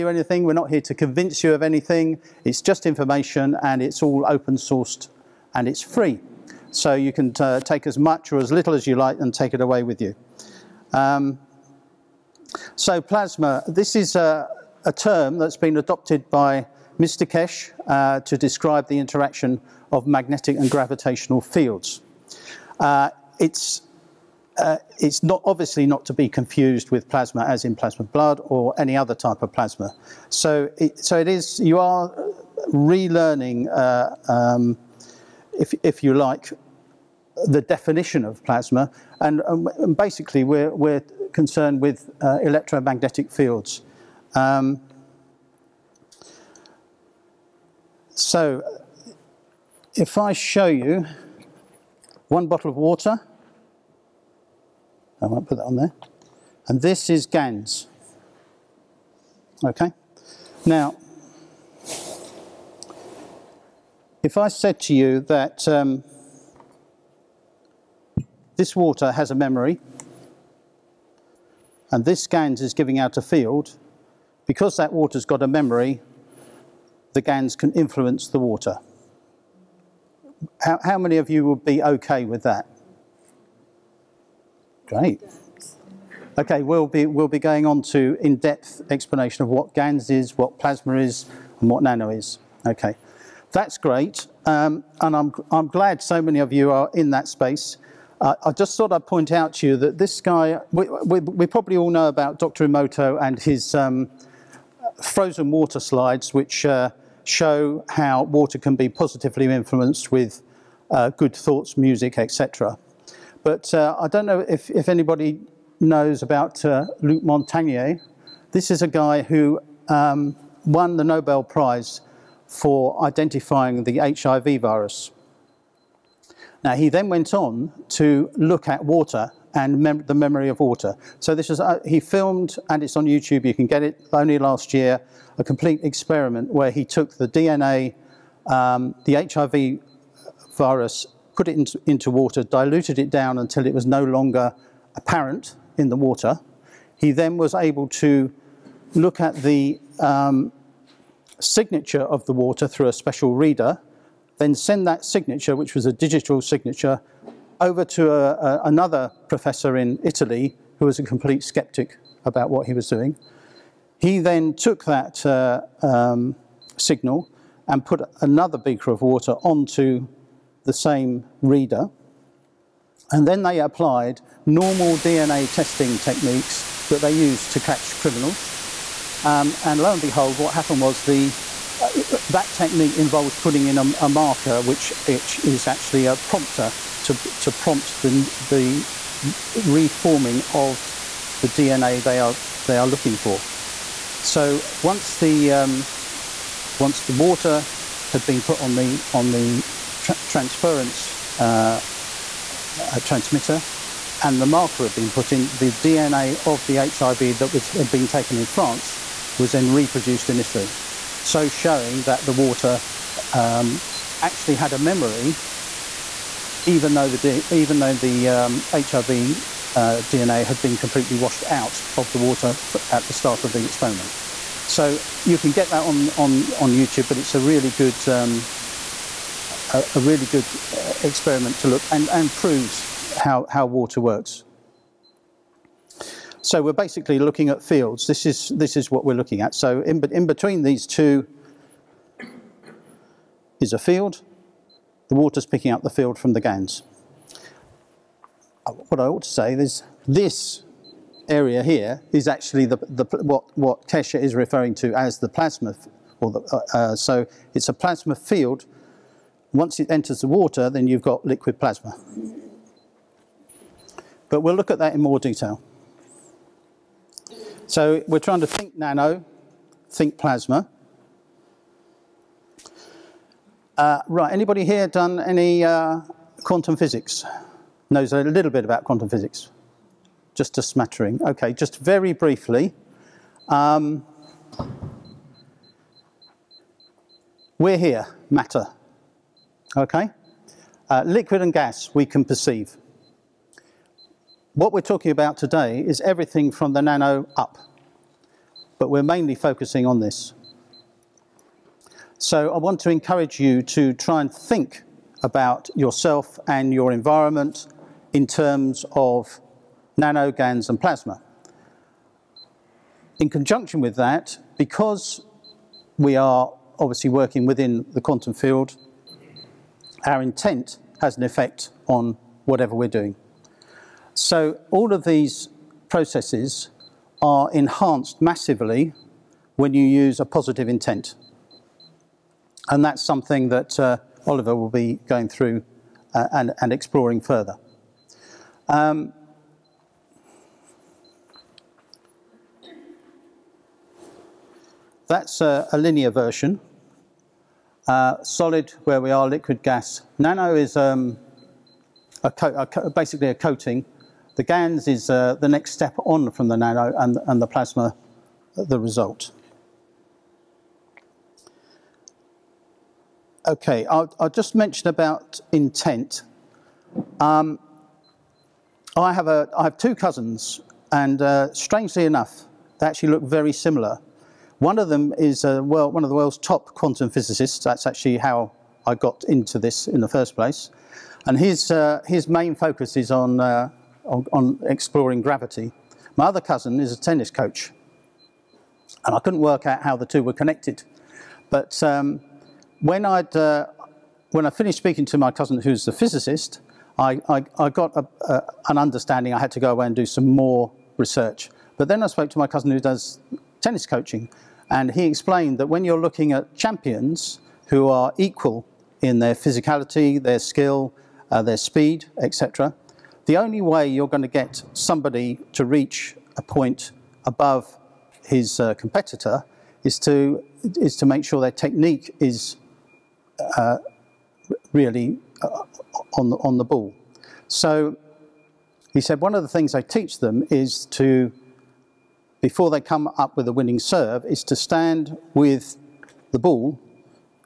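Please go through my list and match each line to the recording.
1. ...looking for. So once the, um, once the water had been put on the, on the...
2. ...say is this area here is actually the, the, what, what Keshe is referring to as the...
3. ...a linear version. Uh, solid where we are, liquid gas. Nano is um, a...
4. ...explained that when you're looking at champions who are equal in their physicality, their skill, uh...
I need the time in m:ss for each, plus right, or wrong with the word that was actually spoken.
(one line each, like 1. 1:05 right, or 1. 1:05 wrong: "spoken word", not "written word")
1. 3:12 right
2. 4:09 right
3. 5:45 right
4. 6:45 right.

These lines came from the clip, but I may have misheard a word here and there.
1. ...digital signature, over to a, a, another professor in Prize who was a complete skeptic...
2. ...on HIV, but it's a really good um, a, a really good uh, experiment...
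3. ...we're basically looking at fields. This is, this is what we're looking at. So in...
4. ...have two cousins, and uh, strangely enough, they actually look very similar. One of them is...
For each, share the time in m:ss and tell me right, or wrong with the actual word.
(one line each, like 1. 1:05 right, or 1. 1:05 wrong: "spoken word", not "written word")
1. 2:35 wrong: "Italy", not "Prize"
2. 3:46 wrong: "YouTube", not "HIV"
3. 3:56 right
4. 6:09 right.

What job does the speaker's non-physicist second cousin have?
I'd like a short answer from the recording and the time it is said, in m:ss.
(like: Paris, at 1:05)
tennis coach, at 6:26.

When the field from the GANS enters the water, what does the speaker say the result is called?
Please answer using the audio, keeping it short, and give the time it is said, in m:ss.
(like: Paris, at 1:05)
liquid plasma, at 4:21.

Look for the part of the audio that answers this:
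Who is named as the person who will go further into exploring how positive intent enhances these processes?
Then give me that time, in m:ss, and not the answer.
5:34.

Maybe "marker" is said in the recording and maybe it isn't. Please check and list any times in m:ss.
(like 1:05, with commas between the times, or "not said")
3:04, 3:24.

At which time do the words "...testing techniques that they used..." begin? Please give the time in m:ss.
2:55.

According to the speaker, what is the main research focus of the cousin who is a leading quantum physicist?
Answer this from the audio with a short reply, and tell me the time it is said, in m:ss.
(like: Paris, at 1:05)
gravity, at 6:25.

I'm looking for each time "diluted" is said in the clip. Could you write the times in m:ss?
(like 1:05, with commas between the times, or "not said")
2:22.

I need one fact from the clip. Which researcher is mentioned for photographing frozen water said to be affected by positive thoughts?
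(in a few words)
Dr. Emoto.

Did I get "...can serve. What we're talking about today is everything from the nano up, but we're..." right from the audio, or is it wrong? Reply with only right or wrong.
wrong.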